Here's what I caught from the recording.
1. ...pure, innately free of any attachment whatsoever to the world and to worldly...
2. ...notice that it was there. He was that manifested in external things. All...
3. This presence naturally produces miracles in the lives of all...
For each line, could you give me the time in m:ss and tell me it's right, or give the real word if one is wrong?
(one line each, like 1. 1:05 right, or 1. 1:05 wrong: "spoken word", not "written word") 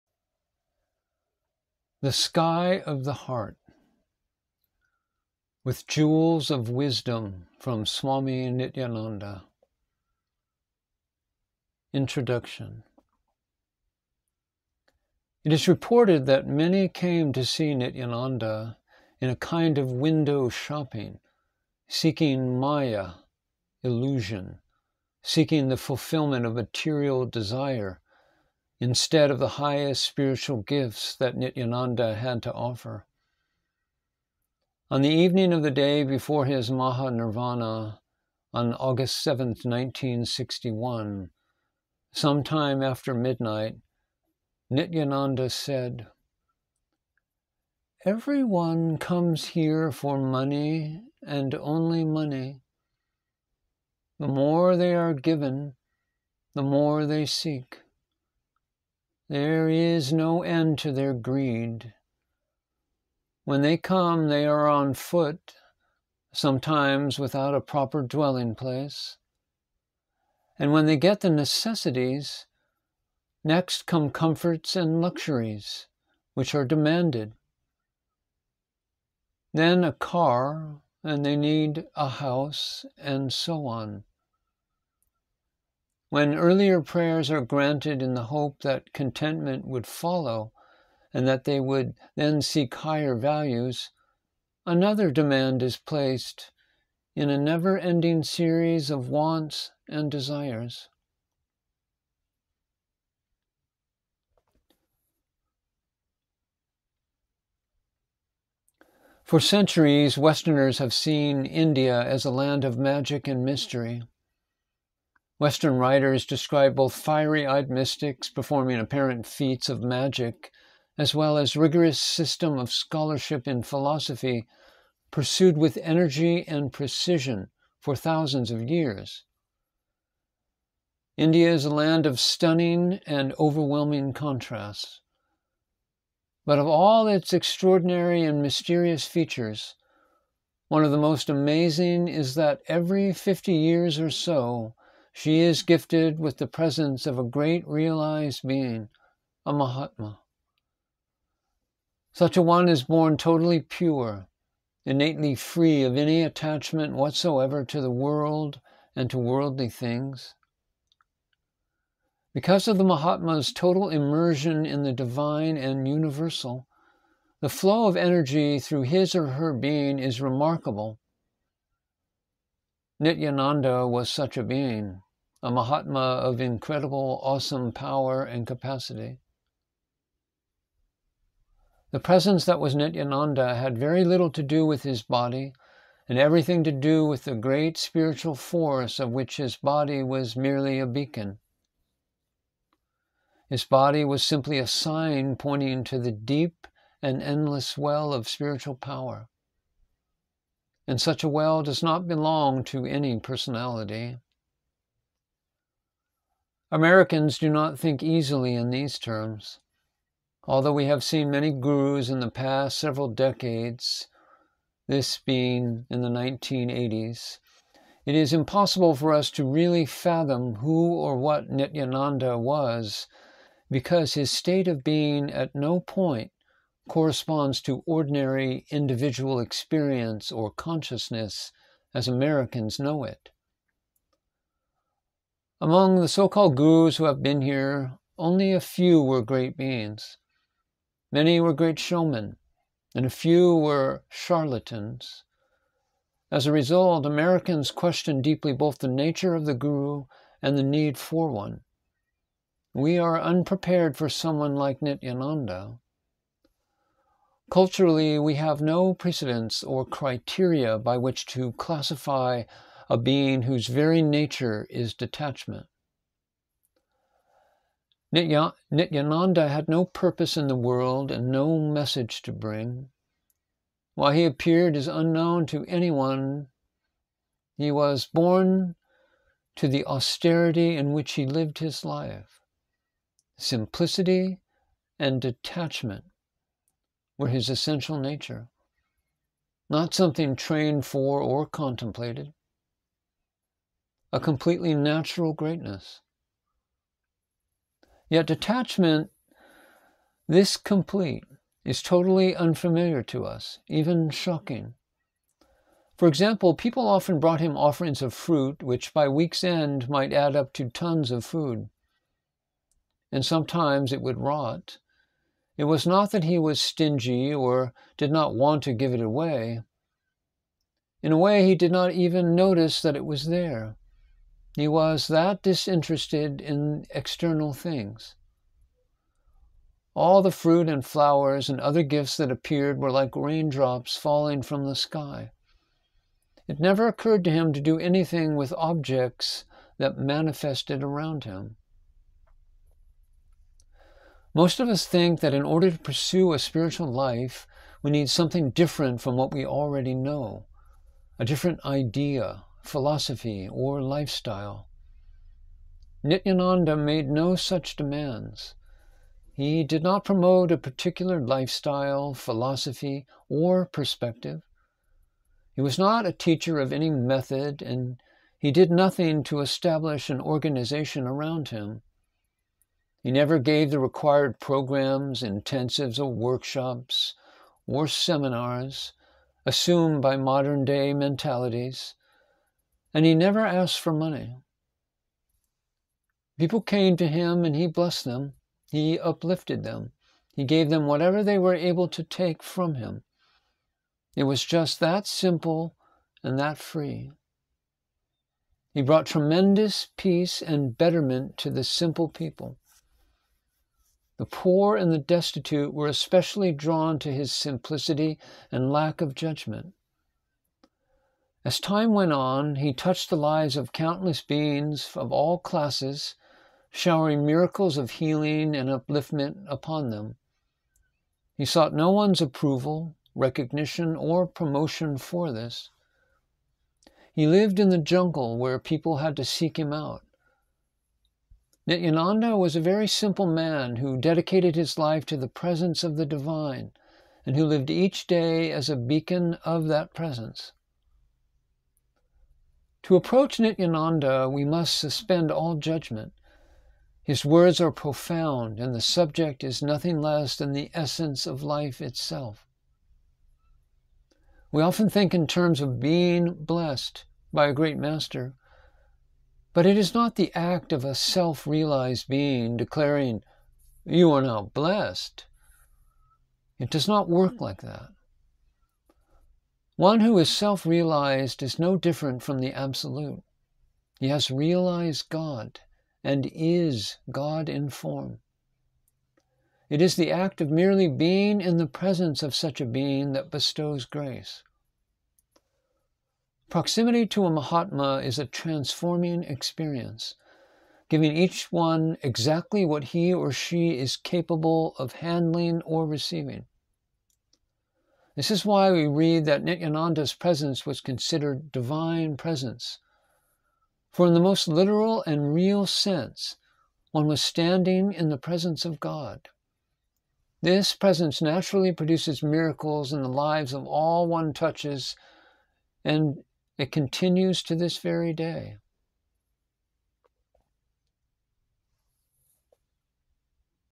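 1. 2:33 right
2. 5:22 wrong: "disinterested", not "manifested"
3. 8:30 right.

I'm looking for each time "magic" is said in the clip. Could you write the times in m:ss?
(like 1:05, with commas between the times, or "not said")
1:52, 1:59.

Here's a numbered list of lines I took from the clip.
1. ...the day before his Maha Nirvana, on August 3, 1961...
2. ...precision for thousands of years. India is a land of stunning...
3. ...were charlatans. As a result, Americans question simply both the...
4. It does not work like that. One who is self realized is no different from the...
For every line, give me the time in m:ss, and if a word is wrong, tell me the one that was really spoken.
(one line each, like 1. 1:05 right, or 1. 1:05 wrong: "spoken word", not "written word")
1. 0:35 wrong: "7", not "3"
2. 2:06 right
3. 4:03 wrong: "deeply", not "simply"
4. 7:46 right.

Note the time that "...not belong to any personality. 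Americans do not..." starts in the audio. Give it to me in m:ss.
3:21.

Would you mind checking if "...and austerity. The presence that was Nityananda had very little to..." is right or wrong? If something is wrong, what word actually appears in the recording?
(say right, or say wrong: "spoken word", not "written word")
wrong: "capacity", not "austerity".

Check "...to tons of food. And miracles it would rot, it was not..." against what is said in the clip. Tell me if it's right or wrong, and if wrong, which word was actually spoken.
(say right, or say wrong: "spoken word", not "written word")
wrong: "sometimes", not "miracles".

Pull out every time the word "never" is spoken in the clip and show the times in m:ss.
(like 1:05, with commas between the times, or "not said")
1:37, 5:36, 6:13, 6:23.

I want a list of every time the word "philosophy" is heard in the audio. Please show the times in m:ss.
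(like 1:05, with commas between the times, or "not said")
2:03, 5:52, 6:02.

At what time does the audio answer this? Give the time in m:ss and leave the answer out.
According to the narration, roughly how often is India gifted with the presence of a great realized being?
2:22.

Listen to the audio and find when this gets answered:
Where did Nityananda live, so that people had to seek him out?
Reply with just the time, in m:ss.
7:07.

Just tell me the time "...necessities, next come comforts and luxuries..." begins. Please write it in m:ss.
1:11.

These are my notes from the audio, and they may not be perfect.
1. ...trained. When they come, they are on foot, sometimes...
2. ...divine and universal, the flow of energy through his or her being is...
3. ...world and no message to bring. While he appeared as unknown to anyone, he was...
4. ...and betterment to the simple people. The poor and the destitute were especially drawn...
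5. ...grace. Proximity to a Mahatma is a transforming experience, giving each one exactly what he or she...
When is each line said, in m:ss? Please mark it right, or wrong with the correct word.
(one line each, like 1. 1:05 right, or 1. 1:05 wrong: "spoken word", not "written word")
1. 1:01 wrong: "greed", not "trained"
2. 2:44 right
3. 4:30 right
4. 6:40 right
5. 8:03 right.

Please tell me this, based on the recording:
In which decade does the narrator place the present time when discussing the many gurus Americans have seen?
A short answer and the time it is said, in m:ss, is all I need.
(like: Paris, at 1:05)
1980s, at 3:36.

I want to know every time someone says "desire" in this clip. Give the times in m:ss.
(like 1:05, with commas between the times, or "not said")
0:27, 1:40.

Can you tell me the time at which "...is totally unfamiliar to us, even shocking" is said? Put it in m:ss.
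5:01.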